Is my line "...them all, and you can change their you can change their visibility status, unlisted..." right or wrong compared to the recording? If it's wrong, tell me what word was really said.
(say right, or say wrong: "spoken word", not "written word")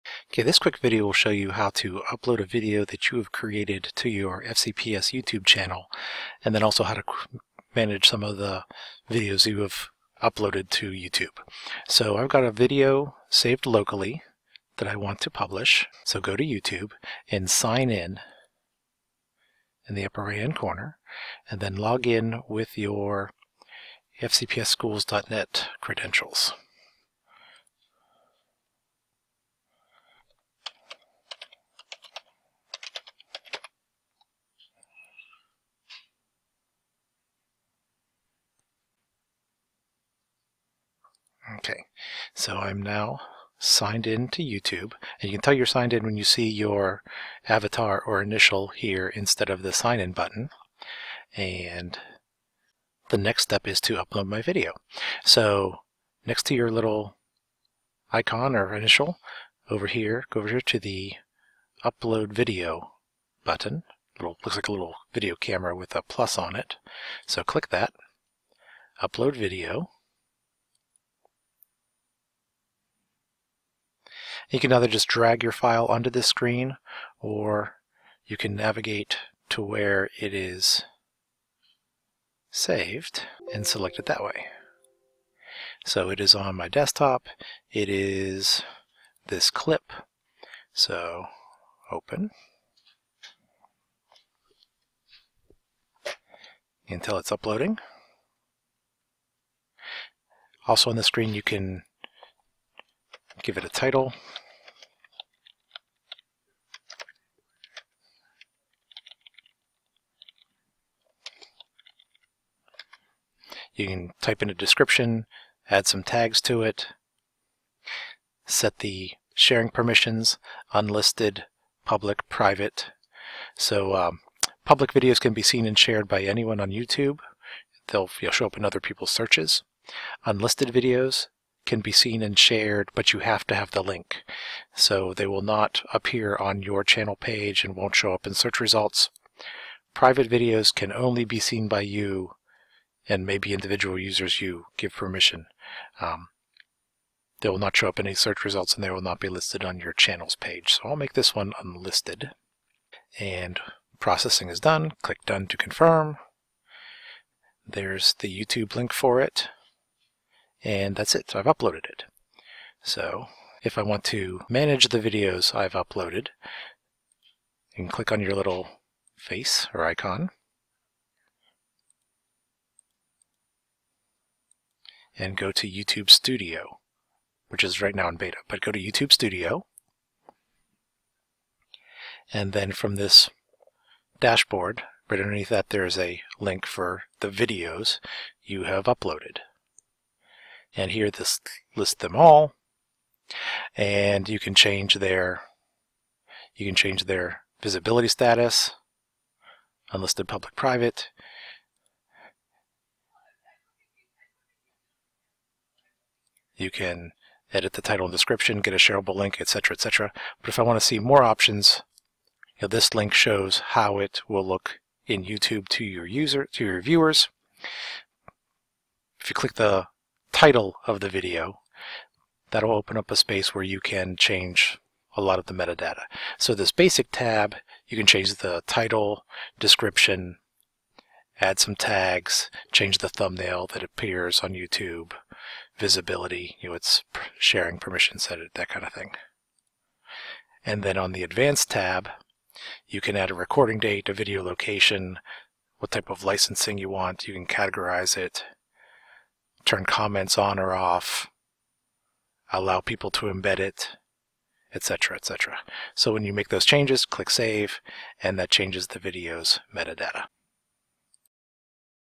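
right.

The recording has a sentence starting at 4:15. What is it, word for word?
So when you make those changes, click Save, and that changes the video's metadata.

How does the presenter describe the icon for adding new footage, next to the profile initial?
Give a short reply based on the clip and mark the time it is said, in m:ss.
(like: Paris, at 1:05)
a little video camera with a plus, at 1:04.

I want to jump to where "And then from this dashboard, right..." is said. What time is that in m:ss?
3:02.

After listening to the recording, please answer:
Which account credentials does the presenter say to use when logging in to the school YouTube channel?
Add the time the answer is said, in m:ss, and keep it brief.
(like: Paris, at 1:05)
fcpsschools.net, at 0:24.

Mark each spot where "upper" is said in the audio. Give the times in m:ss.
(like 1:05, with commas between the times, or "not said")
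0:20.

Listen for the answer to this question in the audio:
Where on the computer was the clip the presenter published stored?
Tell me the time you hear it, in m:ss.
1:26.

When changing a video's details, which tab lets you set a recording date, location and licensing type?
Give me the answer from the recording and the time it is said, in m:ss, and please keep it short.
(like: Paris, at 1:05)
Advanced tab, at 4:01.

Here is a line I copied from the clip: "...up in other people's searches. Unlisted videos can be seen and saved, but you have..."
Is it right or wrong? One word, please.
wrong.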